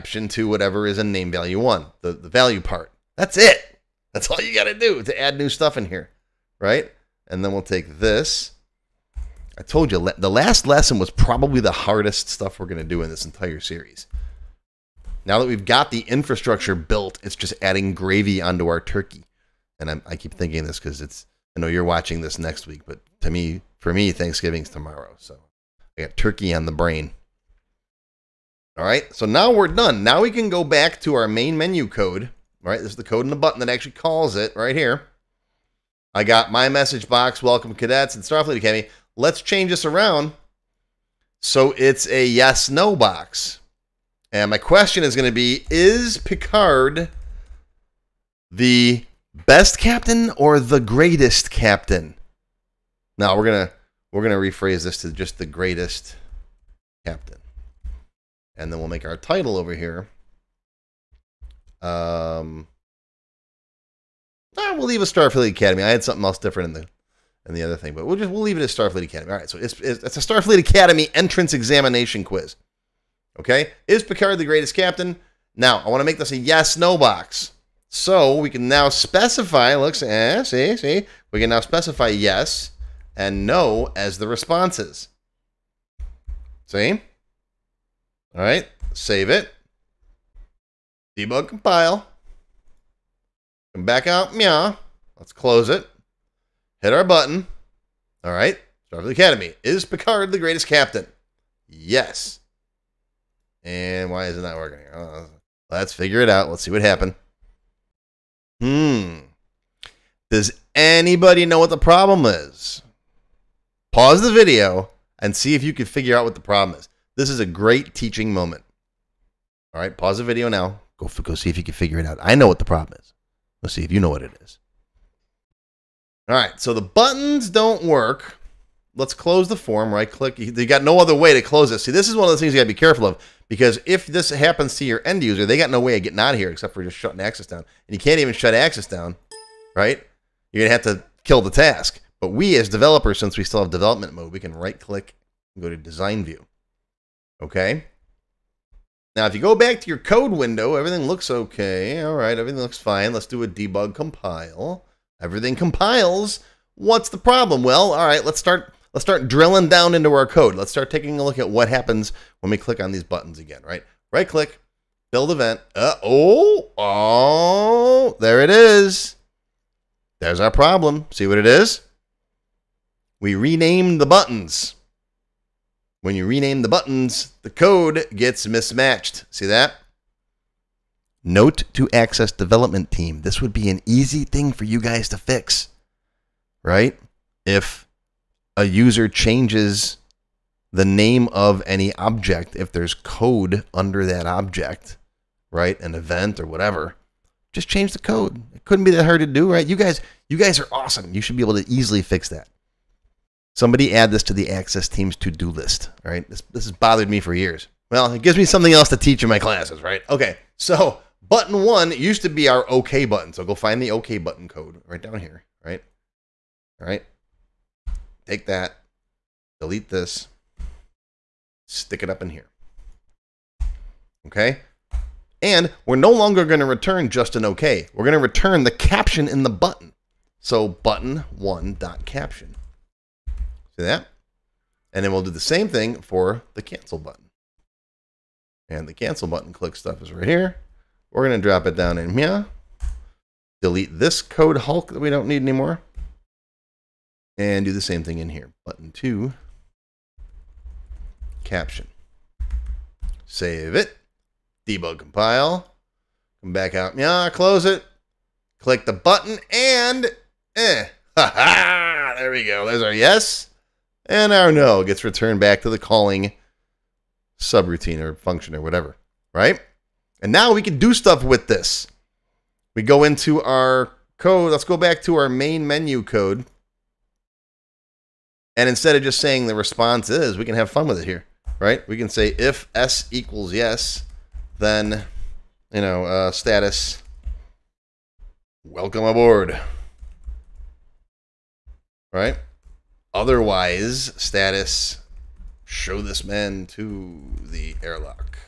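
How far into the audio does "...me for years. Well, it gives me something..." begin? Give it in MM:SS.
03:27.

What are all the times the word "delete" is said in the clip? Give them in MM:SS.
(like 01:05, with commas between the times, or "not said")
03:39, 04:03.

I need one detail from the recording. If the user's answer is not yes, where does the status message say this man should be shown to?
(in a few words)
the airlock.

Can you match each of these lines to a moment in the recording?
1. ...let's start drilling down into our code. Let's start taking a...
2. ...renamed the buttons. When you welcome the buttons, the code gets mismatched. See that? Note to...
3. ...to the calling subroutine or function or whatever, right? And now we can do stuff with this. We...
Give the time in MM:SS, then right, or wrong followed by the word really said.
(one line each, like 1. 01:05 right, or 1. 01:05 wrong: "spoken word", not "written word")
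1. 02:38 right
2. 02:53 wrong: "rename", not "welcome"
3. 04:25 right.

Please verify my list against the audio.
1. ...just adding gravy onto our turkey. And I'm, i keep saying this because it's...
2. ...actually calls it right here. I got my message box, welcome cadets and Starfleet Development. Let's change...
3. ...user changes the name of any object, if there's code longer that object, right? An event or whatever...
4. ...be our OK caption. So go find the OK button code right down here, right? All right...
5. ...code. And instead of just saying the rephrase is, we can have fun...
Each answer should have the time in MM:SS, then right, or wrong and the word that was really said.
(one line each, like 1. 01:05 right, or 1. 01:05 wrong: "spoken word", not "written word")
1. 00:17 wrong: "thinking", not "saying"
2. 00:33 wrong: "Academy", not "Development"
3. 03:08 wrong: "under", not "longer"
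4. 03:32 wrong: "button", not "caption"
5. 04:36 wrong: "response", not "rephrase".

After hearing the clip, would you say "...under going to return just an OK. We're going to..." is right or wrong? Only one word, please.
wrong.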